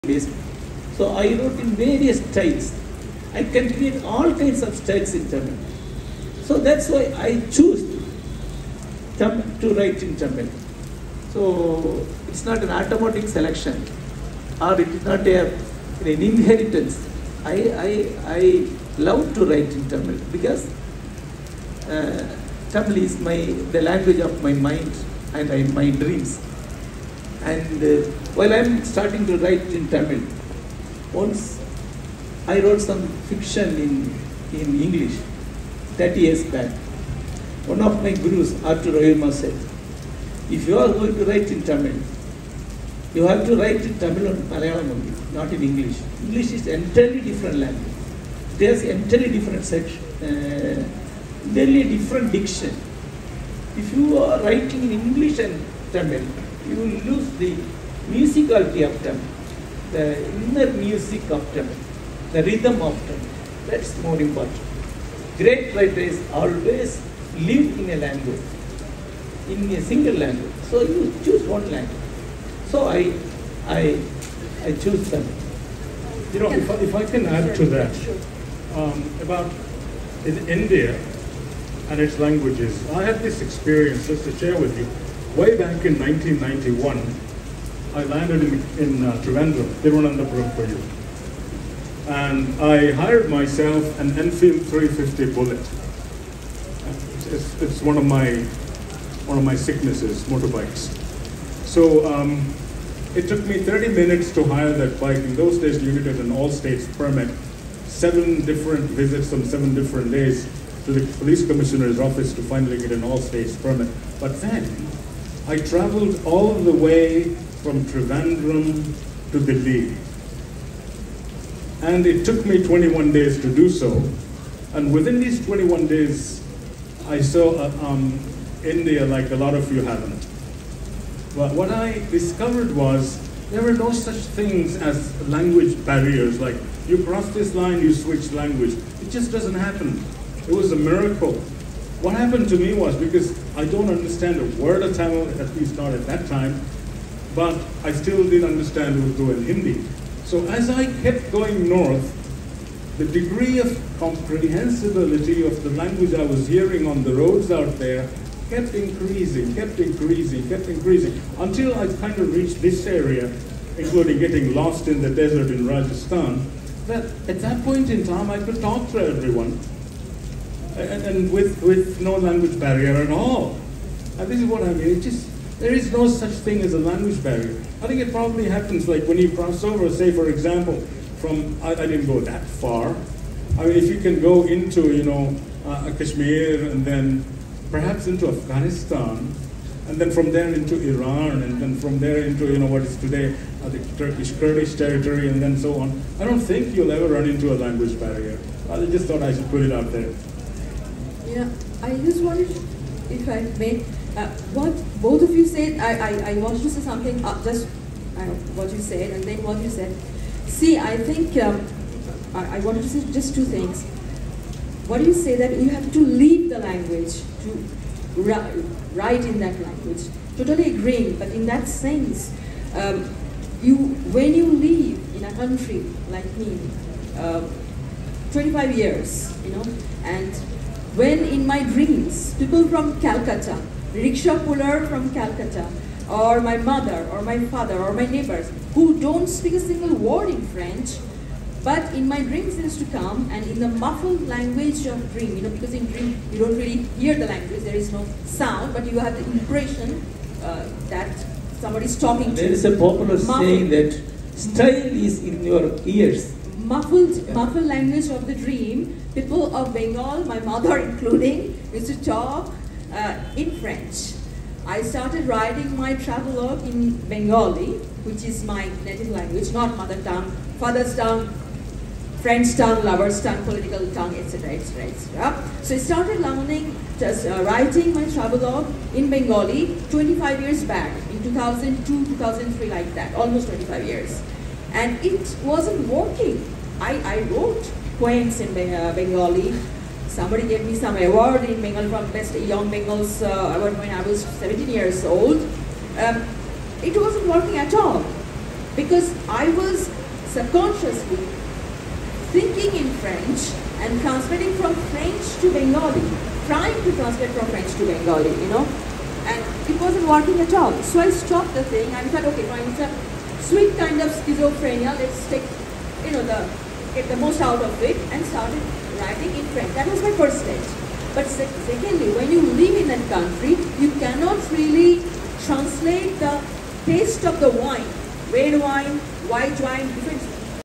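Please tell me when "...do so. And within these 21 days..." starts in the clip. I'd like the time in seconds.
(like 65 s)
123 s.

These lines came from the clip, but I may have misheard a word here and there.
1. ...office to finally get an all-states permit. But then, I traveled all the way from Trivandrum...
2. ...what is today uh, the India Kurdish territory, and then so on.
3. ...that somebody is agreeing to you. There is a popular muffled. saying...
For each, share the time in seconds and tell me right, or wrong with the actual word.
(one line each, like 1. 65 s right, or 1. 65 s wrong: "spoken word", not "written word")
1. 111 s right
2. 192 s wrong: "Turkish", not "India"
3. 250 s wrong: "talking", not "agreeing".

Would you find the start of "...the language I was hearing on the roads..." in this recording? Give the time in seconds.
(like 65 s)
155 s.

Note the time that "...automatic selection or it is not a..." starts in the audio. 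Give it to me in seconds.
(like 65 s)
12 s.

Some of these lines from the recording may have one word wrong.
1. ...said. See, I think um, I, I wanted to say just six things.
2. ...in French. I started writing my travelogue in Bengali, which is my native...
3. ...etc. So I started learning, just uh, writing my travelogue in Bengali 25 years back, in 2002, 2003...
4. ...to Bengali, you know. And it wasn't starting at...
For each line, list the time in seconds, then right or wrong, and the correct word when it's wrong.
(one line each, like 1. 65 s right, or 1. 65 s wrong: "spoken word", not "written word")
1. 209 s wrong: "two", not "six"
2. 263 s right
3. 274 s right
4. 307 s wrong: "working", not "starting".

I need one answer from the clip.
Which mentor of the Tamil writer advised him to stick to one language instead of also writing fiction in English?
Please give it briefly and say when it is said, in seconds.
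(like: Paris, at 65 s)
Arthur Royuma, at 38 s.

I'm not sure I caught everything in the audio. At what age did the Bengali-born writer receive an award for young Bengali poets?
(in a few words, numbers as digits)
17.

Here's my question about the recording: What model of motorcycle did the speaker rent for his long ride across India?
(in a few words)
Enfield 350 Bullet.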